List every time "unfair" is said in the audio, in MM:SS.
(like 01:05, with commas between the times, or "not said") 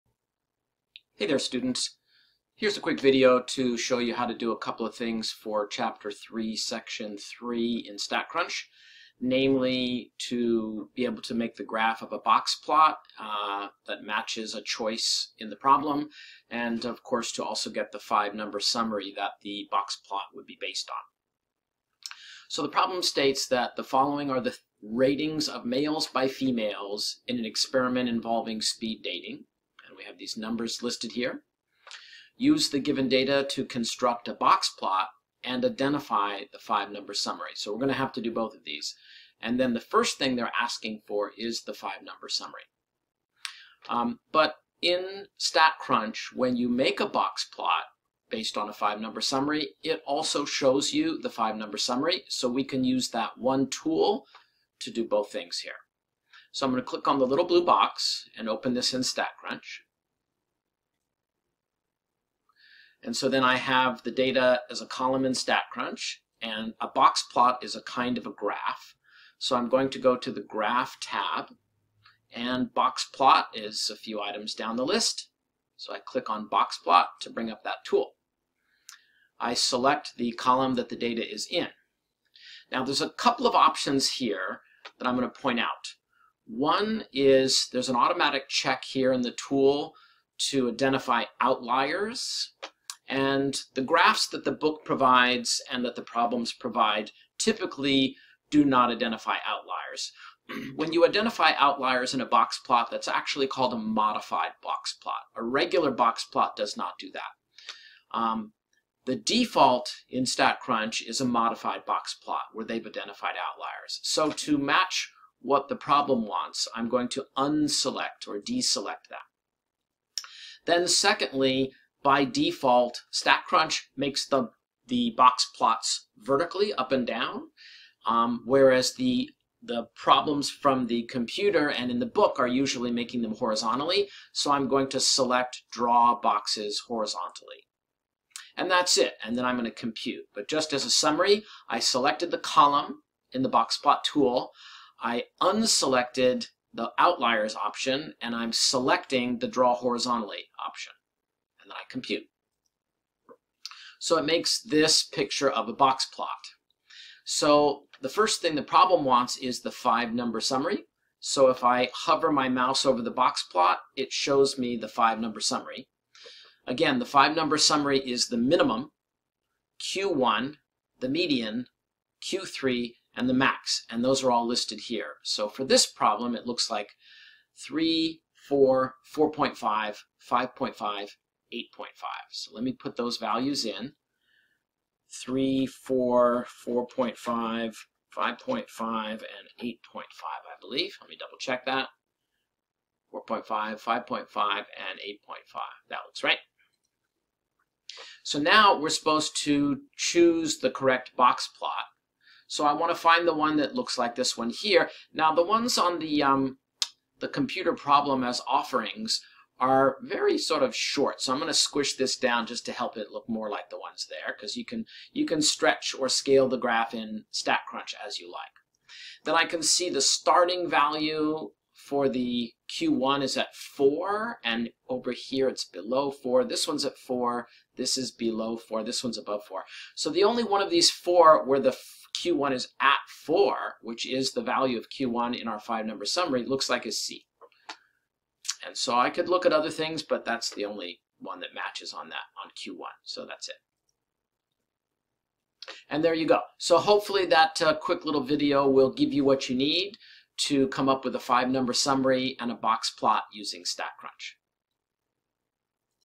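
not said.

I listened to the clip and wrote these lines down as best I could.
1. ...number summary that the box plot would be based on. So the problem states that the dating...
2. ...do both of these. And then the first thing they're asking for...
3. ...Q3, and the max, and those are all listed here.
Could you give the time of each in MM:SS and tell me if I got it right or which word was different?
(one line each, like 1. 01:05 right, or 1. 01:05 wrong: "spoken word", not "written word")
1. 00:18 wrong: "following", not "dating"
2. 00:38 right
3. 02:52 right.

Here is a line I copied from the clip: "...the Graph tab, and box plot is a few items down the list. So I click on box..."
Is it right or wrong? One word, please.
right.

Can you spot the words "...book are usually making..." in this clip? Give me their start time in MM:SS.
02:12.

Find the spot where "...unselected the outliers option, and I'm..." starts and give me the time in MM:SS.
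02:25.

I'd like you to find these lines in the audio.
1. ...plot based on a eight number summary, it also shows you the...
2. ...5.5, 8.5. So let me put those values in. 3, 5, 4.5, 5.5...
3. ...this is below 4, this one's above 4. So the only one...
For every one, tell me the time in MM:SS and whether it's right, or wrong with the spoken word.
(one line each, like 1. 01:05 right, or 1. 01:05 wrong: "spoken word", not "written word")
1. 00:47 wrong: "five", not "eight"
2. 03:00 wrong: "4", not "5"
3. 03:47 right.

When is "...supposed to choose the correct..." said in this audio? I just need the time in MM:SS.
03:18.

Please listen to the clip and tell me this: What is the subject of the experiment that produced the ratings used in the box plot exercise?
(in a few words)
Speed dating.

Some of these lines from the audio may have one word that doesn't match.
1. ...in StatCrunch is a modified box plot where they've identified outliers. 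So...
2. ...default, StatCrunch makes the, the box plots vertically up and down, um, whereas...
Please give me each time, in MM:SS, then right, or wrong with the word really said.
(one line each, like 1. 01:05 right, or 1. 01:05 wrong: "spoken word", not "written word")
1. 01:50 right
2. 02:02 right.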